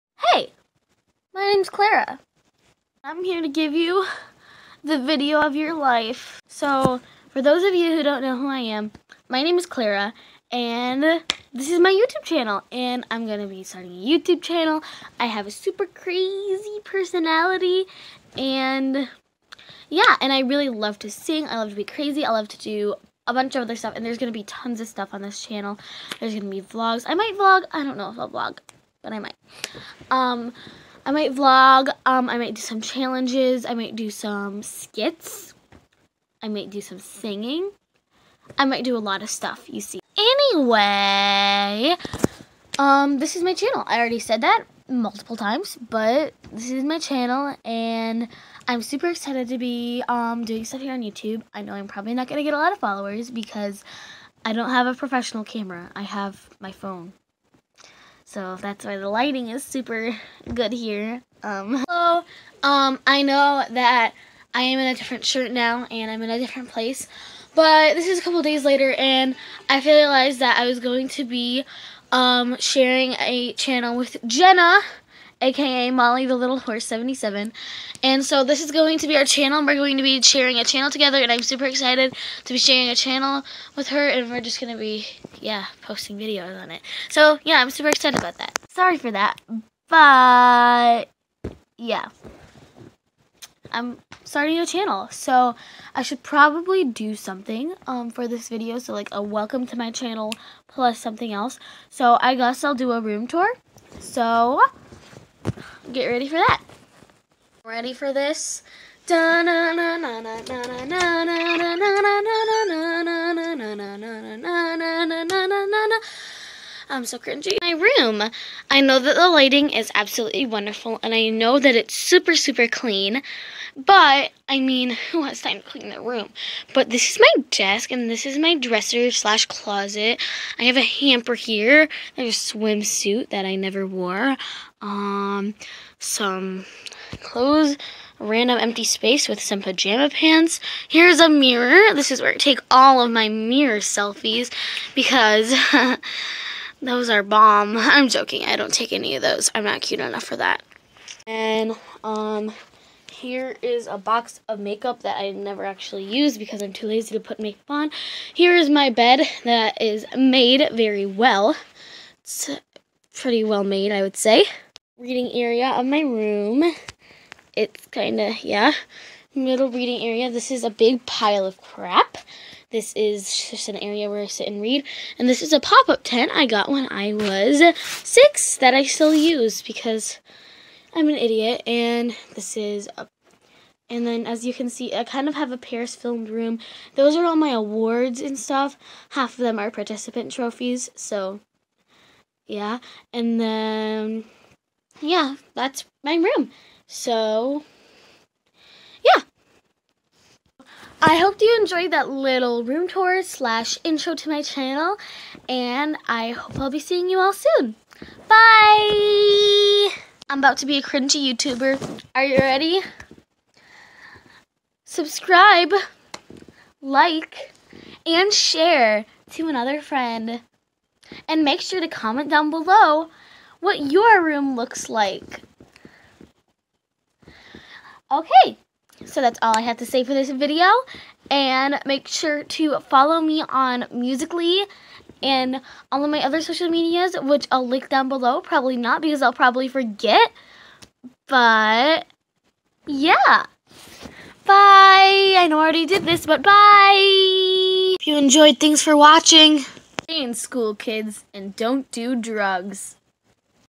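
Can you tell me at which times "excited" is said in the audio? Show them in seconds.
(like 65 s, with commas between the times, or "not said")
49 s, 81 s, 87 s.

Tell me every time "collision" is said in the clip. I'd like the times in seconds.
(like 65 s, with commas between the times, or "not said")
not said.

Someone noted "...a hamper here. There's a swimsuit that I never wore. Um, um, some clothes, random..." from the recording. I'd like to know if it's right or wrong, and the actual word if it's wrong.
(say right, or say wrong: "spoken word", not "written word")
right.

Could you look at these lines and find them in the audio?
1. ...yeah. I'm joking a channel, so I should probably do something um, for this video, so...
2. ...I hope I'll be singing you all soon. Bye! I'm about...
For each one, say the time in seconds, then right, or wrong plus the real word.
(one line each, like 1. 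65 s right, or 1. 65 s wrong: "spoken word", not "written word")
1. 91 s wrong: "starting", not "joking"
2. 206 s wrong: "seeing", not "singing".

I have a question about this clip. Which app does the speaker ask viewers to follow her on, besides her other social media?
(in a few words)
Musical.ly.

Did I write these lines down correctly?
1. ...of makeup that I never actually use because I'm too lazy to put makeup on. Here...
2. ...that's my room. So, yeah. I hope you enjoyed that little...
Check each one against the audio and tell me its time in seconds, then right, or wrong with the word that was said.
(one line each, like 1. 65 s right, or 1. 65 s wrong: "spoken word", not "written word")
1. 154 s right
2. 195 s right.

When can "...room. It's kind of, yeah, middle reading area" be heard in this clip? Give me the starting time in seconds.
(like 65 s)
166 s.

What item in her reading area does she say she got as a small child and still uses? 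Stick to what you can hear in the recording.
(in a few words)
Pop-up tent.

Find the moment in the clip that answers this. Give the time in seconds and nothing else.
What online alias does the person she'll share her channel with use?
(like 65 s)
75 s.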